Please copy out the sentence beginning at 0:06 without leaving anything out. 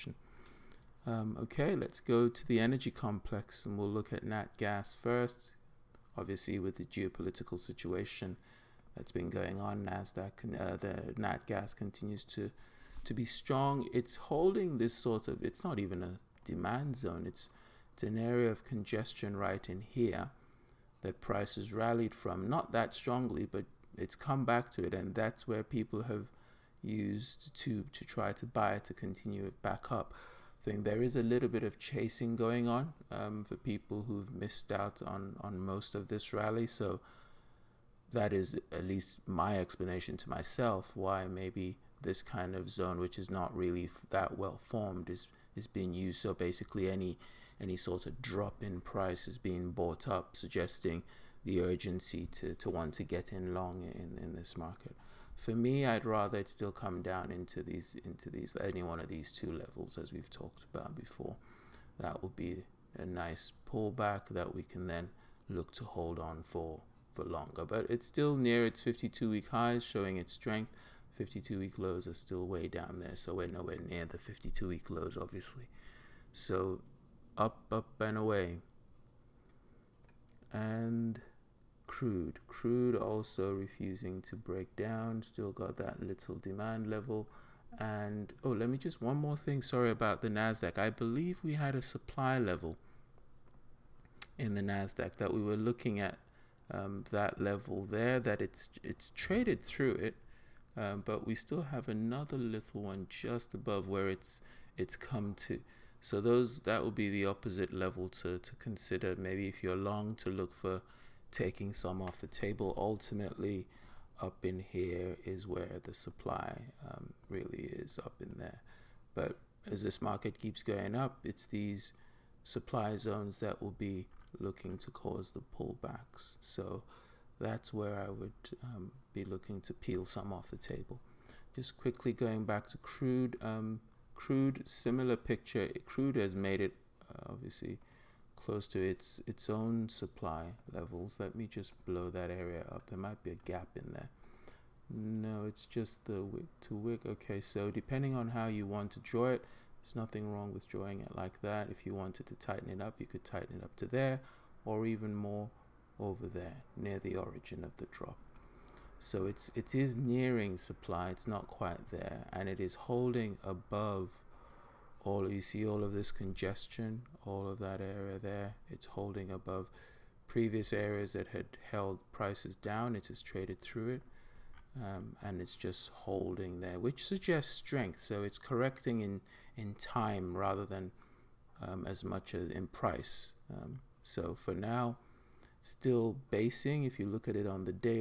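Obviously, with the geopolitical situation that's been going on, Nasdaq uh, the nat gas continues to to be strong.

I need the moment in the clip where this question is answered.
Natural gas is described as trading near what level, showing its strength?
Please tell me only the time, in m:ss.
1:08.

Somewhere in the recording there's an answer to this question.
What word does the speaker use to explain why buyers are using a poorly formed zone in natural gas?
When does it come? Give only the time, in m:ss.
0:31.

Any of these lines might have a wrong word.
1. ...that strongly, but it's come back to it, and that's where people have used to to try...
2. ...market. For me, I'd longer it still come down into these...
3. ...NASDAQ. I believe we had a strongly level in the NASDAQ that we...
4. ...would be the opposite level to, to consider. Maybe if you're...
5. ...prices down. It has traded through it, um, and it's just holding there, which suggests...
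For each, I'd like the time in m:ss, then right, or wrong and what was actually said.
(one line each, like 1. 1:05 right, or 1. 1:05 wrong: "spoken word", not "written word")
1. 0:22 right
2. 0:54 wrong: "rather", not "longer"
3. 1:30 wrong: "supply", not "strongly"
4. 1:46 right
5. 2:52 right.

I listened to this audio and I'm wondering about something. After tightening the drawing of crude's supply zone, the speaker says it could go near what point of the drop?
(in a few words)
The origin.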